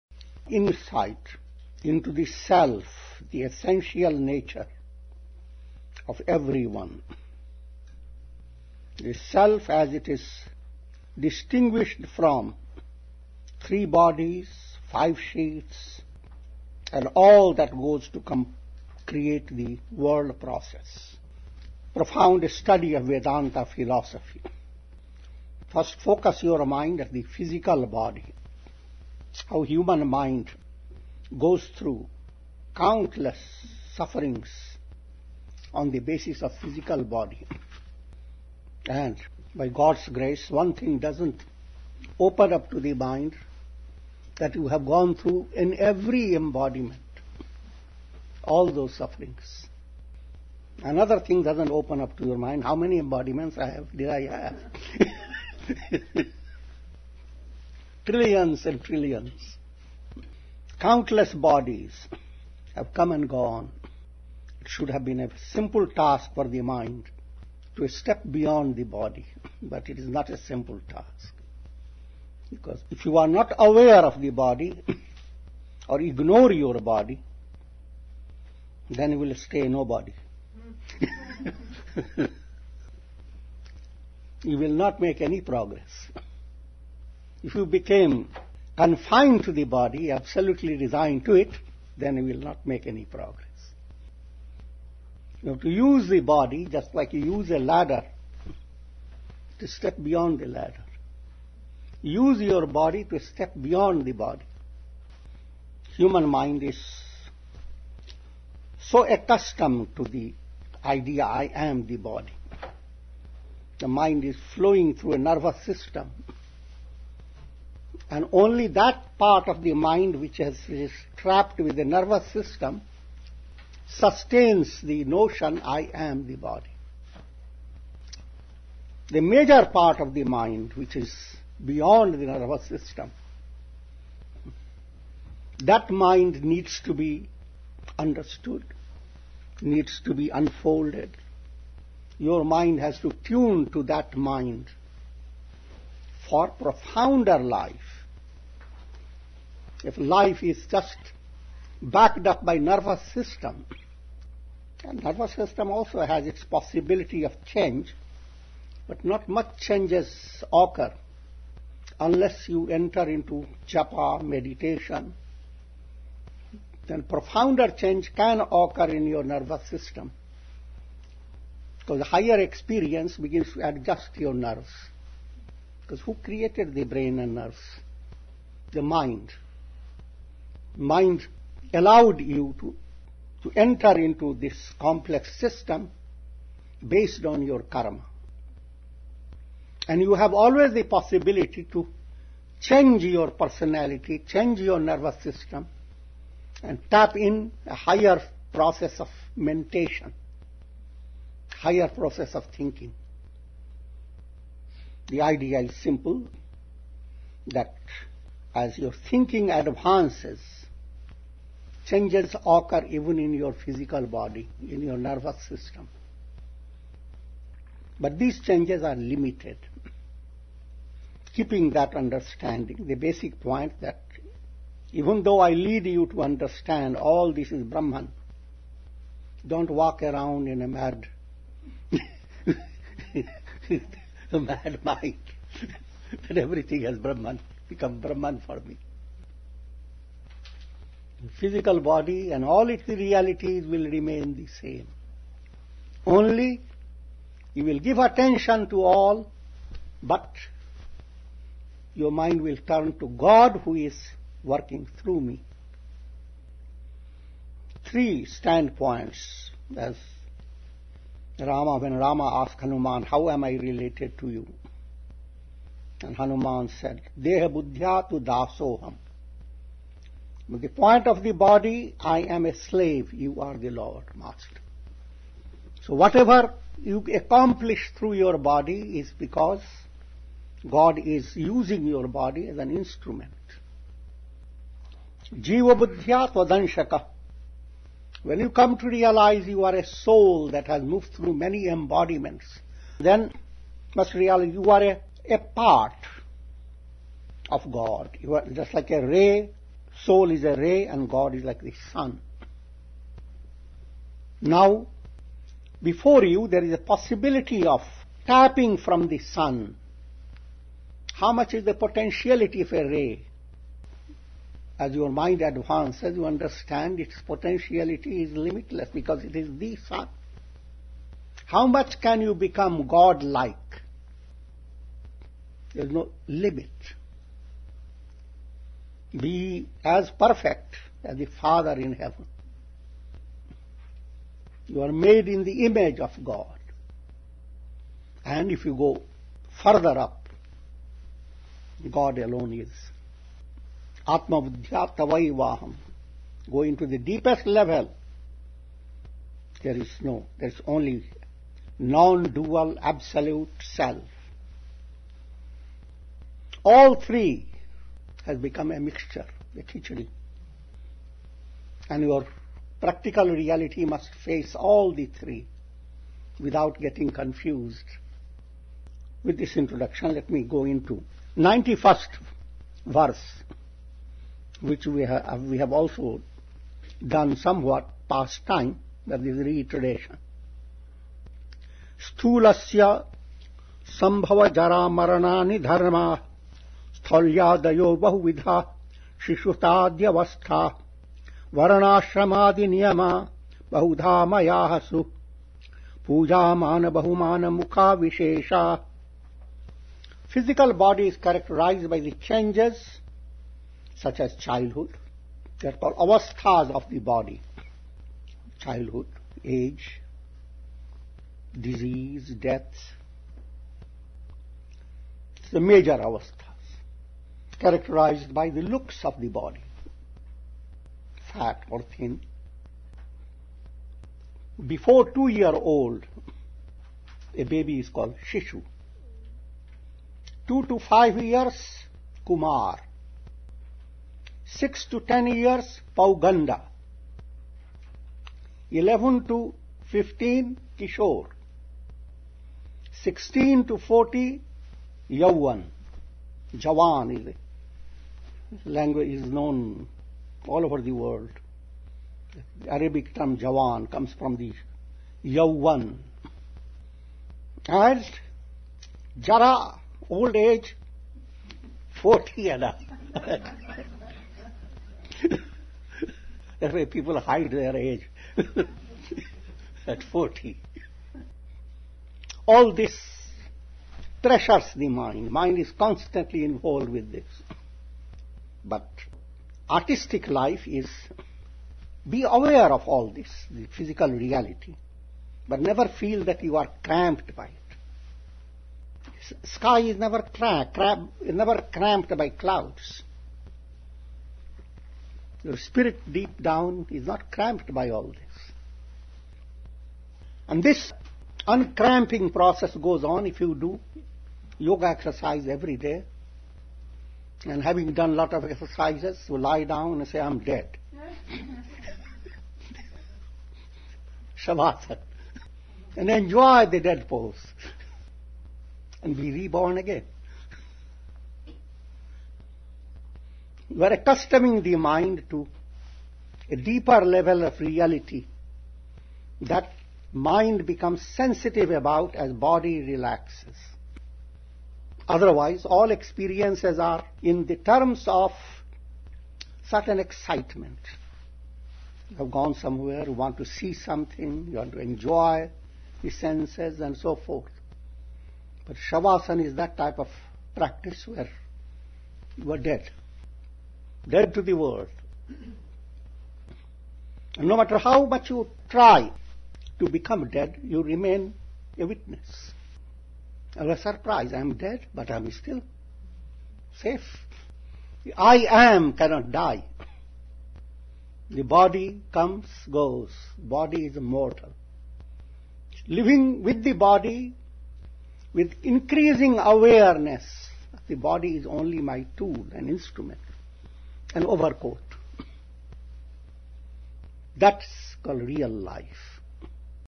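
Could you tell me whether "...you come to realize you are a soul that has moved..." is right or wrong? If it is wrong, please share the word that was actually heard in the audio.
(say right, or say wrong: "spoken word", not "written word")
right.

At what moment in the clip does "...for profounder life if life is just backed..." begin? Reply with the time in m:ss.
2:26.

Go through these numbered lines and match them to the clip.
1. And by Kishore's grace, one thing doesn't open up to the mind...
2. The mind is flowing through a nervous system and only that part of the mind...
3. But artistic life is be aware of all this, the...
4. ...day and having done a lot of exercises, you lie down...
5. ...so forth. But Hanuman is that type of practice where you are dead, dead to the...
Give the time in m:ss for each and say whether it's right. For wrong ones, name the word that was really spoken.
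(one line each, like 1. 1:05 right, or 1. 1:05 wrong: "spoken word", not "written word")
1. 0:38 wrong: "God", not "Kishore"
2. 1:53 right
3. 7:58 right
4. 8:25 right
5. 9:06 wrong: "Shavasana", not "Hanuman".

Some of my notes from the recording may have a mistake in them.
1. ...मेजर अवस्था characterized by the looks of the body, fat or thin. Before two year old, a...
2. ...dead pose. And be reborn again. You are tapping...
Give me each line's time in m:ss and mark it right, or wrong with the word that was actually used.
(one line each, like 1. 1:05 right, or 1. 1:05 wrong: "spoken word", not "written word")
1. 6:55 right
2. 8:36 wrong: "accustoming", not "tapping".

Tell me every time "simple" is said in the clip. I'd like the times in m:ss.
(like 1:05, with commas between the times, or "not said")
1:05, 1:10, 3:25.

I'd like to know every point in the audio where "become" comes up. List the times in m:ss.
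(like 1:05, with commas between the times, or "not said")
3:57, 5:22, 5:58, 8:50, 9:19.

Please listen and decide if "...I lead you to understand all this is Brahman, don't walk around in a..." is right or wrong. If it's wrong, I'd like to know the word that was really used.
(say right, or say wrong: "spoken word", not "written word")
right.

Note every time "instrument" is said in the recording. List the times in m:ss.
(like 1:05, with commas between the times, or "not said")
4:42, 9:42.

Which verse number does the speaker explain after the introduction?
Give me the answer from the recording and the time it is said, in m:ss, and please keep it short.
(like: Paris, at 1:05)
91st, at 6:11.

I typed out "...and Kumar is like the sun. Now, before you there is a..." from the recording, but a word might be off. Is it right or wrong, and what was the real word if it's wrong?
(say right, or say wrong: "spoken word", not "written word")
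wrong: "God", not "Kumar".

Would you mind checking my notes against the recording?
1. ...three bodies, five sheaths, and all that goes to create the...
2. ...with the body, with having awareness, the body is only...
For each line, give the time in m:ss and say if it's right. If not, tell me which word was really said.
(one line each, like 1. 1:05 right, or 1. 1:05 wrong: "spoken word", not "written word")
1. 0:13 right
2. 9:36 wrong: "increasing", not "having".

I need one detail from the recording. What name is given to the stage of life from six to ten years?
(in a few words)
Pauganda.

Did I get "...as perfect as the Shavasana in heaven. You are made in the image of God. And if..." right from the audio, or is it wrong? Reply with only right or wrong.
wrong.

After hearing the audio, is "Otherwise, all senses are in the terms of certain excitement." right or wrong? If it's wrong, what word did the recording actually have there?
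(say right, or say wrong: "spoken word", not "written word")
wrong: "experiences", not "senses".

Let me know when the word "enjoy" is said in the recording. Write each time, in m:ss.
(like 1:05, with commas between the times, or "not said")
8:36, 9:04.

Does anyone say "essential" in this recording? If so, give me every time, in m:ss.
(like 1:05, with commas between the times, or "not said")
0:03.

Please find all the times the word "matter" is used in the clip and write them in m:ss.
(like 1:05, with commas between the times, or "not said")
9:17.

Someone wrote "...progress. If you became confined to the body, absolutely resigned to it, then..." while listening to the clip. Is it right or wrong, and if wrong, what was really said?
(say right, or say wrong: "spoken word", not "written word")
right.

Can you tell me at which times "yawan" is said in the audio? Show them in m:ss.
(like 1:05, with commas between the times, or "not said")
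7:25, 7:35.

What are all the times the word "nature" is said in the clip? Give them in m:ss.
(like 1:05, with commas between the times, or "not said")
0:04.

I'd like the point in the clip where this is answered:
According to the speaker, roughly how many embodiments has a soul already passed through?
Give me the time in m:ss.
0:58.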